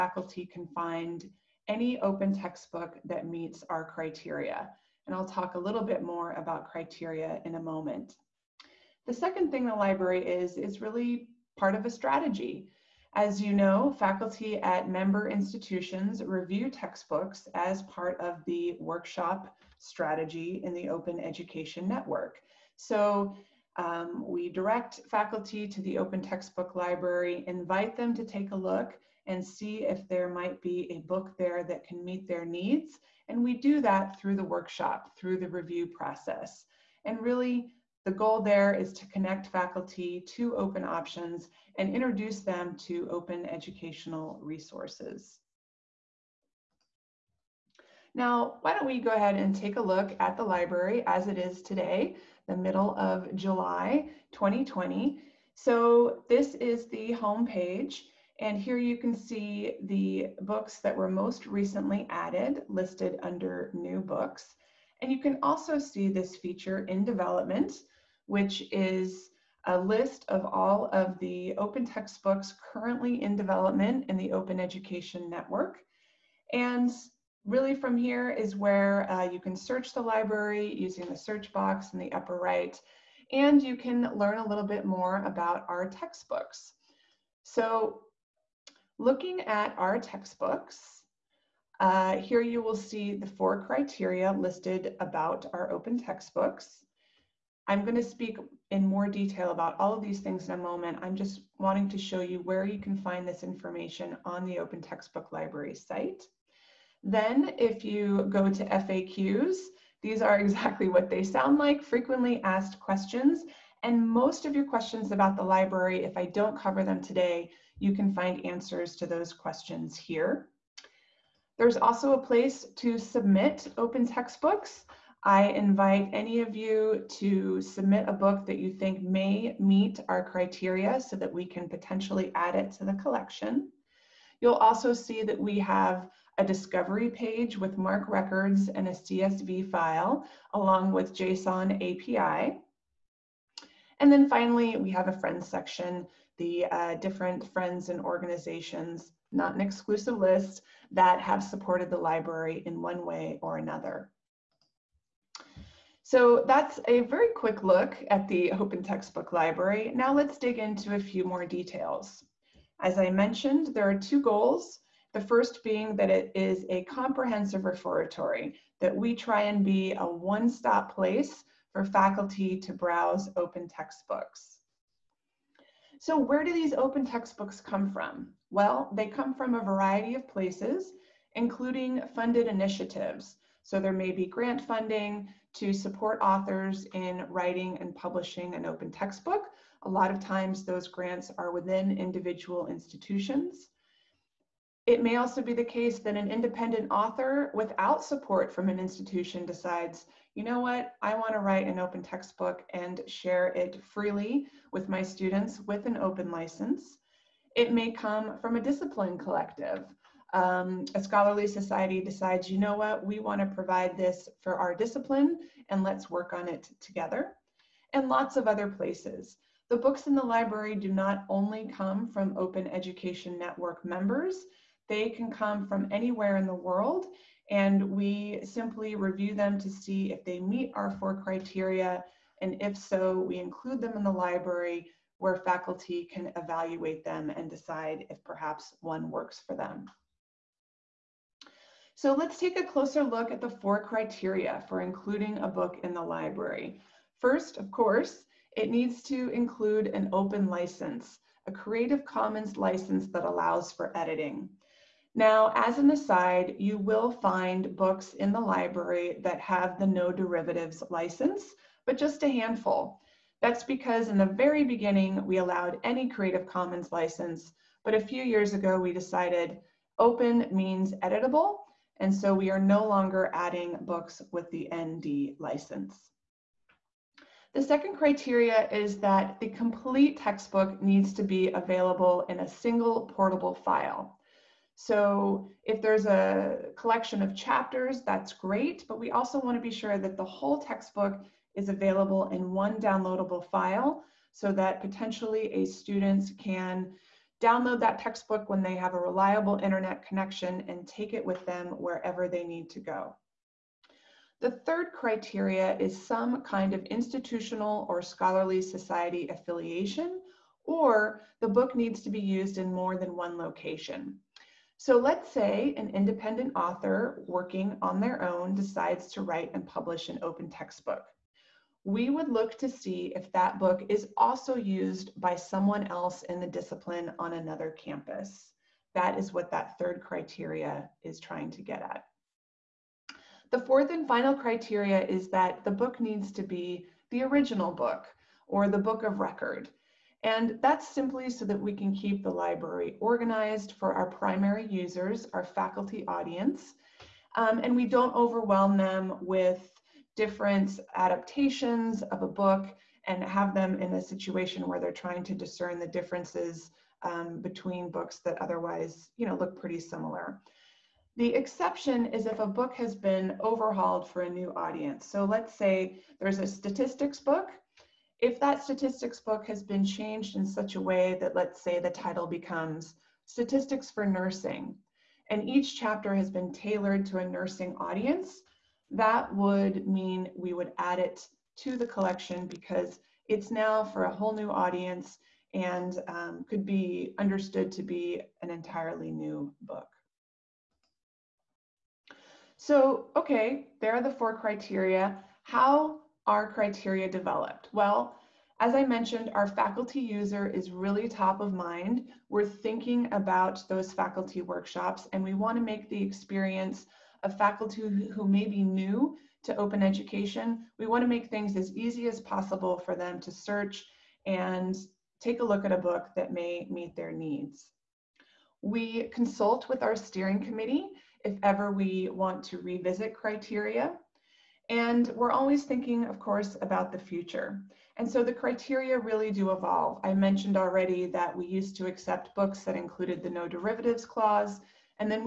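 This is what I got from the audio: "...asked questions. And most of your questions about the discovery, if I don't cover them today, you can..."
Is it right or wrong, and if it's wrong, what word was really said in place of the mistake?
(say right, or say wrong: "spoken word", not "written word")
wrong: "library", not "discovery".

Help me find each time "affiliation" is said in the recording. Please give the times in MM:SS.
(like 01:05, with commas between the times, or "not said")
05:09.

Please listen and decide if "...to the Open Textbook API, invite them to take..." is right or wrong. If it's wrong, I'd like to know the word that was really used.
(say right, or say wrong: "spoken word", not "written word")
wrong: "Library", not "API".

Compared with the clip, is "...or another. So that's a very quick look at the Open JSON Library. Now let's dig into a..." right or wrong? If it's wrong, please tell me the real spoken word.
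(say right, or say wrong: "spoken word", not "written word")
wrong: "Textbook", not "JSON".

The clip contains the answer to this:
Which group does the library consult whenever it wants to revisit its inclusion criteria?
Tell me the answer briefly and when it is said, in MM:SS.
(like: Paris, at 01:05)
steering committee, at 06:59.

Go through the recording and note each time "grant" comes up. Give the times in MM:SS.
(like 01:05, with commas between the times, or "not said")
03:04, 03:10.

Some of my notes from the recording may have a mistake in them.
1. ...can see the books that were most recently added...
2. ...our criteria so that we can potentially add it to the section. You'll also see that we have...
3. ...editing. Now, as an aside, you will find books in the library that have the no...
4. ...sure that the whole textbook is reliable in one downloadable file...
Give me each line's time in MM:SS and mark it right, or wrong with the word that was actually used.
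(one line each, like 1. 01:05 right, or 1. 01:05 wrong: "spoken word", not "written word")
1. 00:58 right
2. 02:10 wrong: "collection", not "section"
3. 04:13 right
4. 04:49 wrong: "available", not "reliable".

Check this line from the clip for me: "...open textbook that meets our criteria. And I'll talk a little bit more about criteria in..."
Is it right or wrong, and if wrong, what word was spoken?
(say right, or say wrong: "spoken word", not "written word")
right.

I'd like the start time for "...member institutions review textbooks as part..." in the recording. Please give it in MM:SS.
00:14.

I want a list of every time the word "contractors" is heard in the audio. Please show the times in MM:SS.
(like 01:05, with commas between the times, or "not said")
not said.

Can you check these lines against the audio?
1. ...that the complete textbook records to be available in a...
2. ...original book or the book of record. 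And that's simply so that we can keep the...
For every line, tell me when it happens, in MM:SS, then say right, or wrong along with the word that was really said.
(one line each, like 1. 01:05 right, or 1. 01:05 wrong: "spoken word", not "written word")
1. 04:39 wrong: "needs", not "records"
2. 05:37 right.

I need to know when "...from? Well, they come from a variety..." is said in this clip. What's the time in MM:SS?
02:57.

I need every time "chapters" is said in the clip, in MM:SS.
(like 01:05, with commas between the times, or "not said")
04:47, 06:15.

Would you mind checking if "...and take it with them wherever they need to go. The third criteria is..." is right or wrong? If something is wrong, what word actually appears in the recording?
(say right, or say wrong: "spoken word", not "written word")
right.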